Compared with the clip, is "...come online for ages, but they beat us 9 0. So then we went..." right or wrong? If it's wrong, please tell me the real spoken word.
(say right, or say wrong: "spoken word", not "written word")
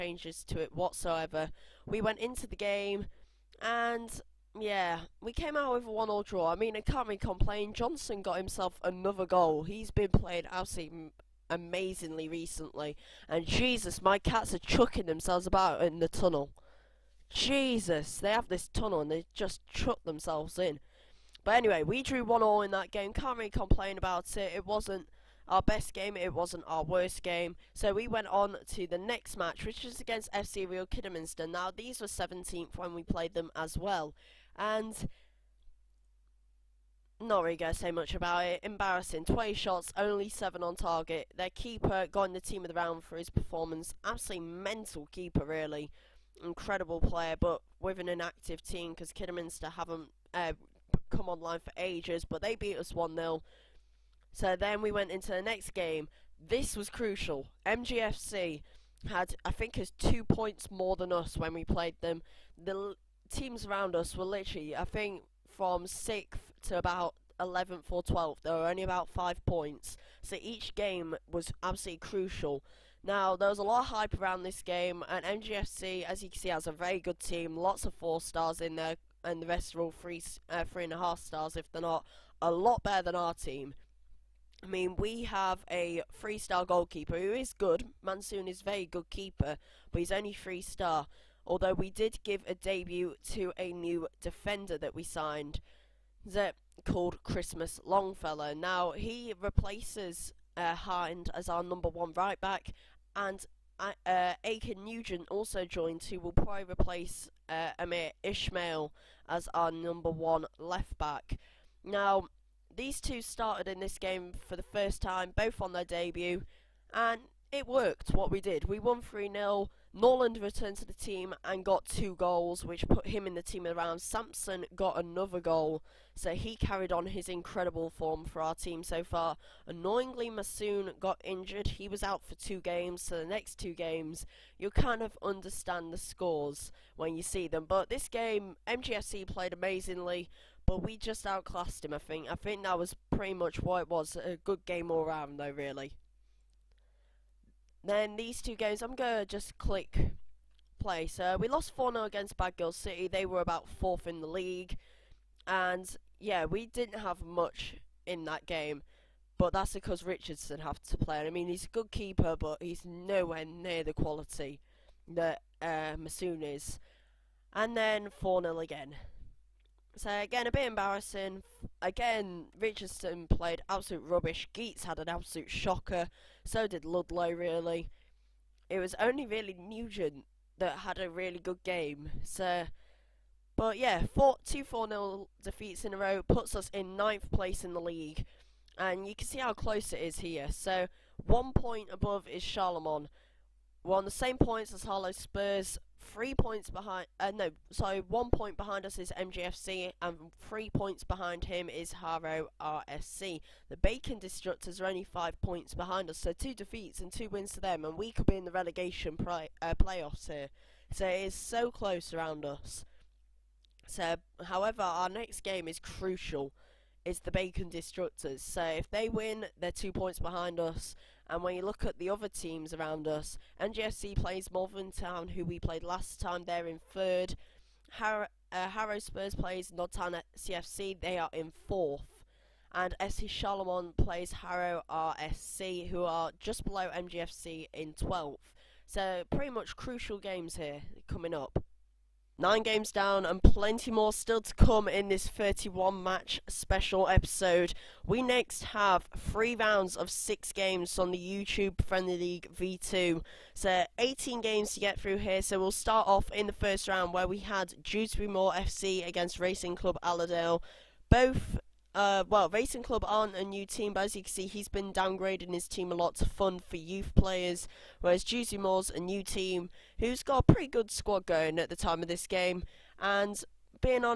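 wrong: "1", not "9".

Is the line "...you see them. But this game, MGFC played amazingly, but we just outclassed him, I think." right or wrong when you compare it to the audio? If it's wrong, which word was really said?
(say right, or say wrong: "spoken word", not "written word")
right.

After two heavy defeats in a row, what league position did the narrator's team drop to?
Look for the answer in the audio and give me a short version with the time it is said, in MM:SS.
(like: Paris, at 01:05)
9th, at 03:06.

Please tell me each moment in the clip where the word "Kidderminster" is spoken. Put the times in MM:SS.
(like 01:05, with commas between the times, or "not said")
00:30, 00:49.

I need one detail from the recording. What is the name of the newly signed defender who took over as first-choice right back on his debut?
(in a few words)
Christmas Longfellow.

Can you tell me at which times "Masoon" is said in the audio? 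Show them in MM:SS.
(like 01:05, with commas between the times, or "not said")
02:10, 02:45.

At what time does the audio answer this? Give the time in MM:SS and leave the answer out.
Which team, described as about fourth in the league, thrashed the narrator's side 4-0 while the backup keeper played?
02:32.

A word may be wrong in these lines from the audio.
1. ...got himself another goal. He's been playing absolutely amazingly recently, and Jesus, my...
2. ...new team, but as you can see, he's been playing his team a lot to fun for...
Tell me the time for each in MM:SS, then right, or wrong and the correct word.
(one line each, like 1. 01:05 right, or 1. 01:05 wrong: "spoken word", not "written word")
1. 00:08 right
2. 04:23 wrong: "downgrading", not "playing".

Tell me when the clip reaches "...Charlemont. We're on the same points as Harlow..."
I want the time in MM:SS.
03:12.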